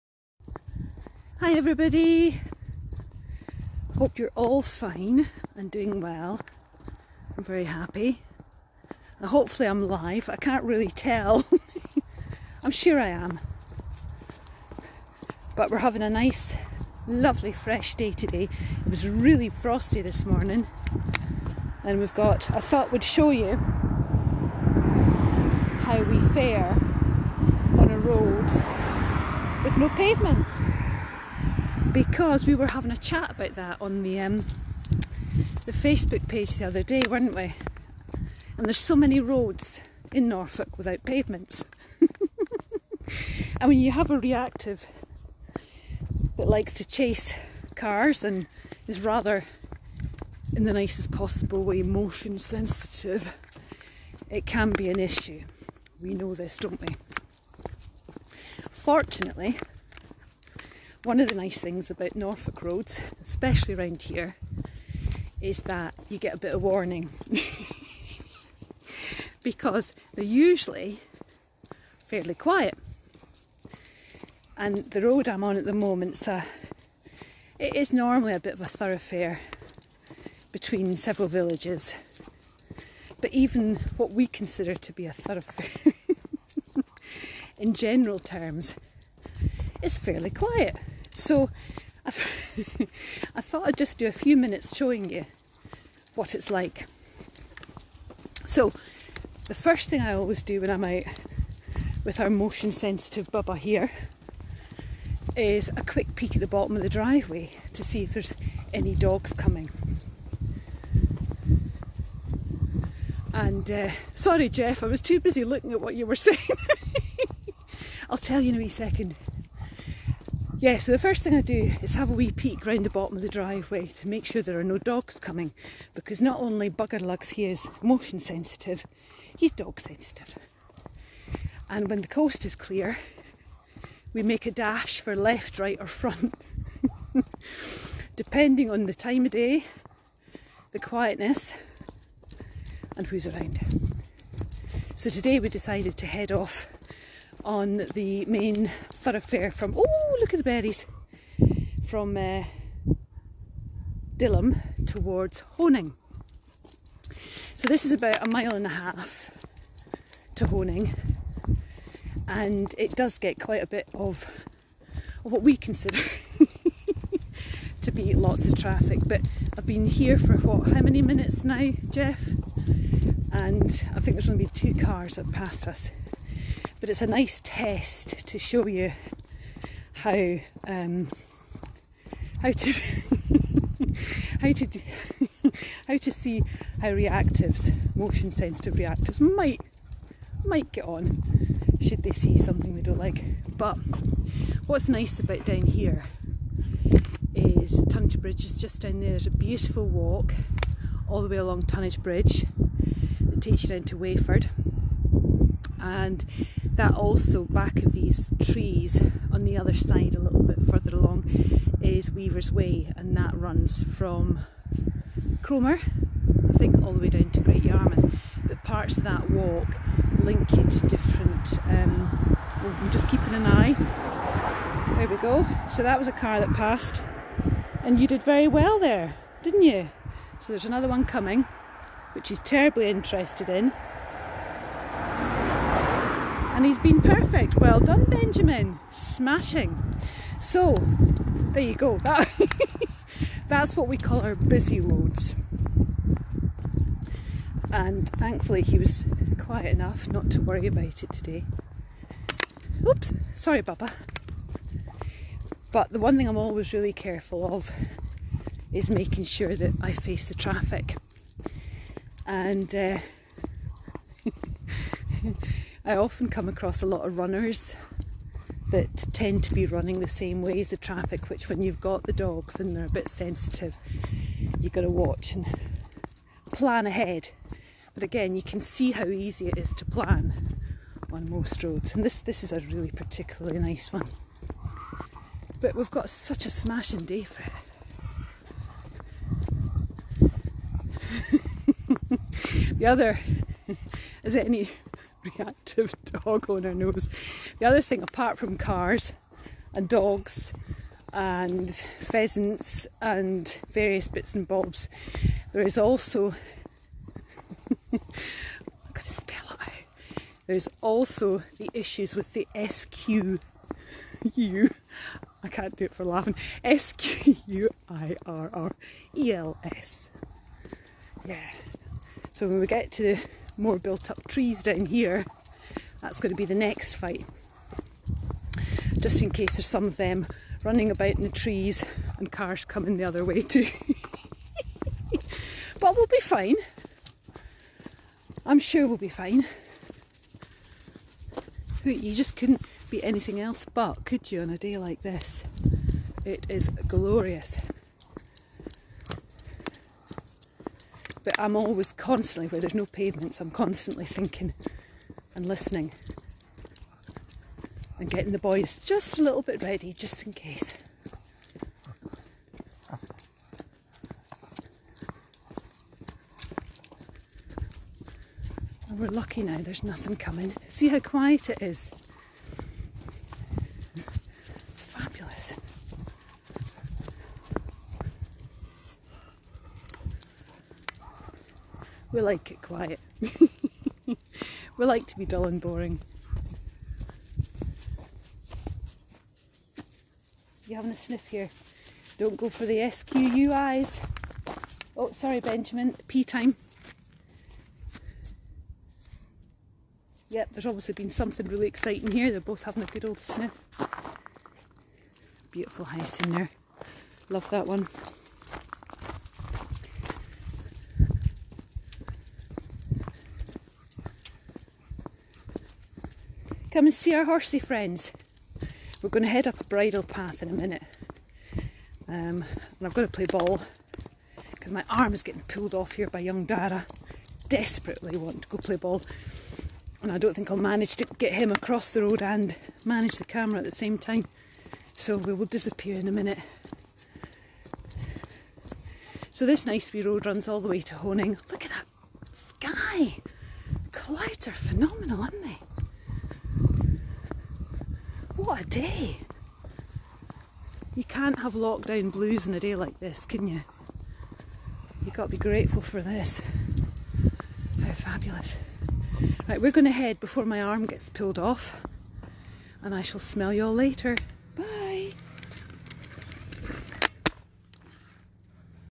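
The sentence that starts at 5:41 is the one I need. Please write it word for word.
You just couldn't be anything else but, could you, on a day like this?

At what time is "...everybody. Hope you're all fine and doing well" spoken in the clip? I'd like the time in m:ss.
0:01.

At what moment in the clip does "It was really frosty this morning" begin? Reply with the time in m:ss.
0:18.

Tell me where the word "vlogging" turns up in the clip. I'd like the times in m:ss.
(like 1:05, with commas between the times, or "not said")
not said.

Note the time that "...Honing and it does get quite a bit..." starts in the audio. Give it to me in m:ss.
2:40.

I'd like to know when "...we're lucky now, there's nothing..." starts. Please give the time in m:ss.
6:08.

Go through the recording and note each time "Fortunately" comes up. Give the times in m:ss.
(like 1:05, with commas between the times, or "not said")
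0:58.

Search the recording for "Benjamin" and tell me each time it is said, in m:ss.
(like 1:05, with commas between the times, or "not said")
3:58, 6:35.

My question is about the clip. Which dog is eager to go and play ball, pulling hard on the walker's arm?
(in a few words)
Dara.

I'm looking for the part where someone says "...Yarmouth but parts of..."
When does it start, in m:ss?
3:37.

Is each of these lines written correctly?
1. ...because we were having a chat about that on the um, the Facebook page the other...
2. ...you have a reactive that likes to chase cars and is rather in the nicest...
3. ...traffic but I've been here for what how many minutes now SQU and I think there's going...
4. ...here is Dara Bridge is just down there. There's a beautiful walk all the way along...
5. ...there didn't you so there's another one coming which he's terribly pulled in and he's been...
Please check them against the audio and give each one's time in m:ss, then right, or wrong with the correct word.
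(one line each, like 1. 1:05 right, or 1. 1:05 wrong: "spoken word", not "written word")
1. 0:31 right
2. 0:43 right
3. 2:48 wrong: "Jeff", not "SQU"
4. 3:15 wrong: "Tonnage", not "Dara"
5. 3:48 wrong: "interested", not "pulled".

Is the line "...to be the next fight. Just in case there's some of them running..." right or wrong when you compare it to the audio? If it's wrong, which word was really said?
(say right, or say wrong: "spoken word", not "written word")
right.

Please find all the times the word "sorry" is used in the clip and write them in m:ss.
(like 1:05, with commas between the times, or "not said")
1:54, 4:13, 6:35.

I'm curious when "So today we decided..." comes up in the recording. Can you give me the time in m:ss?
2:24.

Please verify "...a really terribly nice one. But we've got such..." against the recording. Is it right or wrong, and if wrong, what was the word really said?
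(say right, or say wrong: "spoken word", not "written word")
wrong: "particularly", not "terribly".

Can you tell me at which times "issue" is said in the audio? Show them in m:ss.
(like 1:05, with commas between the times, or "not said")
0:54, 5:11.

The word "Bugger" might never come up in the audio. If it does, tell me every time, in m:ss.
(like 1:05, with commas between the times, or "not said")
2:06.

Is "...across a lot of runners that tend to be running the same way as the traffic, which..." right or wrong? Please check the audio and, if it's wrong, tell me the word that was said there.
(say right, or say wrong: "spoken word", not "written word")
right.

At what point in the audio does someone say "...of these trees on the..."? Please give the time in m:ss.
3:27.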